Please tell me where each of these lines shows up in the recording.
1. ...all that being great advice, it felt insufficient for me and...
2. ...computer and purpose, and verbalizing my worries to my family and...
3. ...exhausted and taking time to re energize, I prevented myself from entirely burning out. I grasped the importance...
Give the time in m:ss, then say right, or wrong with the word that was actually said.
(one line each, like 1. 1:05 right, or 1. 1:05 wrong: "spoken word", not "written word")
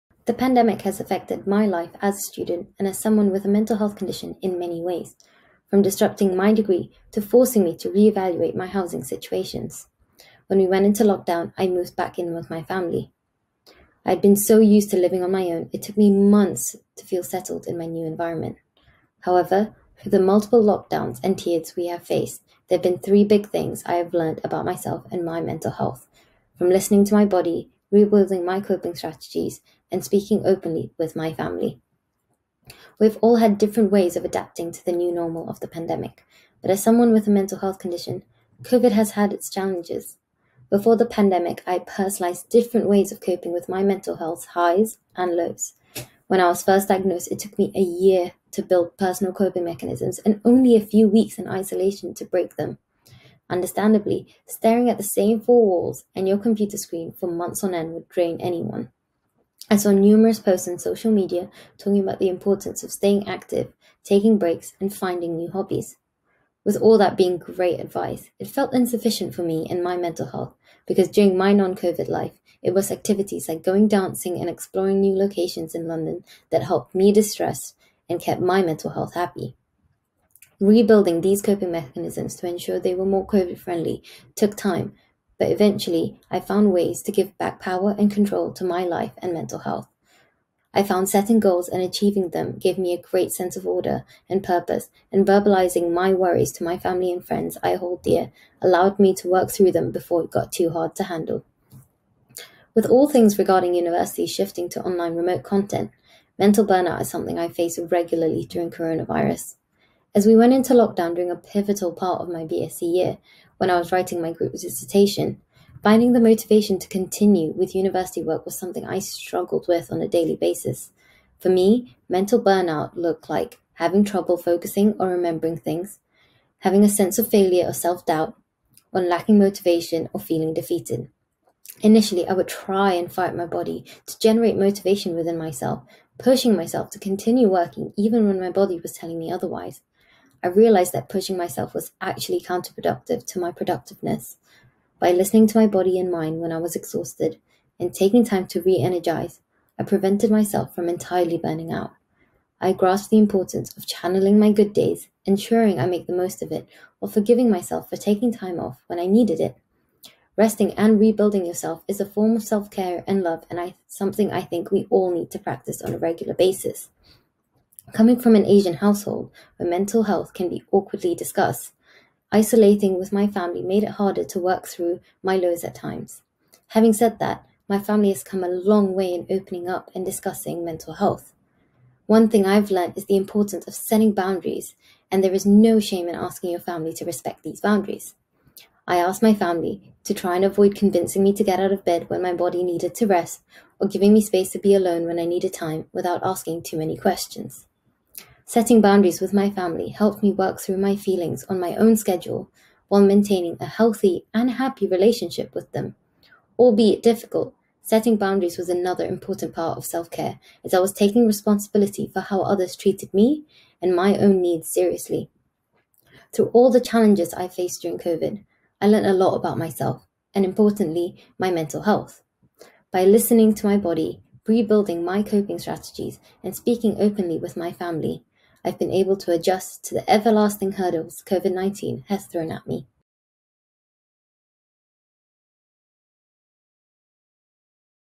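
1. 1:06 right
2. 1:33 wrong: "order", not "computer"
3. 2:26 right.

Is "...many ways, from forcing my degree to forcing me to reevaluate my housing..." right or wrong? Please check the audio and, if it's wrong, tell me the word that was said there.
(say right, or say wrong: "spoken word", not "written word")
wrong: "disrupting", not "forcing".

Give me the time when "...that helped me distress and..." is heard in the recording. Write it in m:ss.
1:16.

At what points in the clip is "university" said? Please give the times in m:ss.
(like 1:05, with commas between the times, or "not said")
1:43, 1:57.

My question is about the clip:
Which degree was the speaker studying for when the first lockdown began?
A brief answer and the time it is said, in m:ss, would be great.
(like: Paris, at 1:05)
BSc, at 1:52.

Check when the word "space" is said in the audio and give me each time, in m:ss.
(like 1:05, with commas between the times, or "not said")
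3:14.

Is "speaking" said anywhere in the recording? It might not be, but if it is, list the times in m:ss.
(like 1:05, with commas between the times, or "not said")
0:30, 3:46.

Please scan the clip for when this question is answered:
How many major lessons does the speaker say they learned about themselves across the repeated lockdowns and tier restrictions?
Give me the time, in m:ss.
0:22.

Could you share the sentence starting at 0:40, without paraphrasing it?
Before the pandemic, I personalized different ways of coping with my mental health highs and lows.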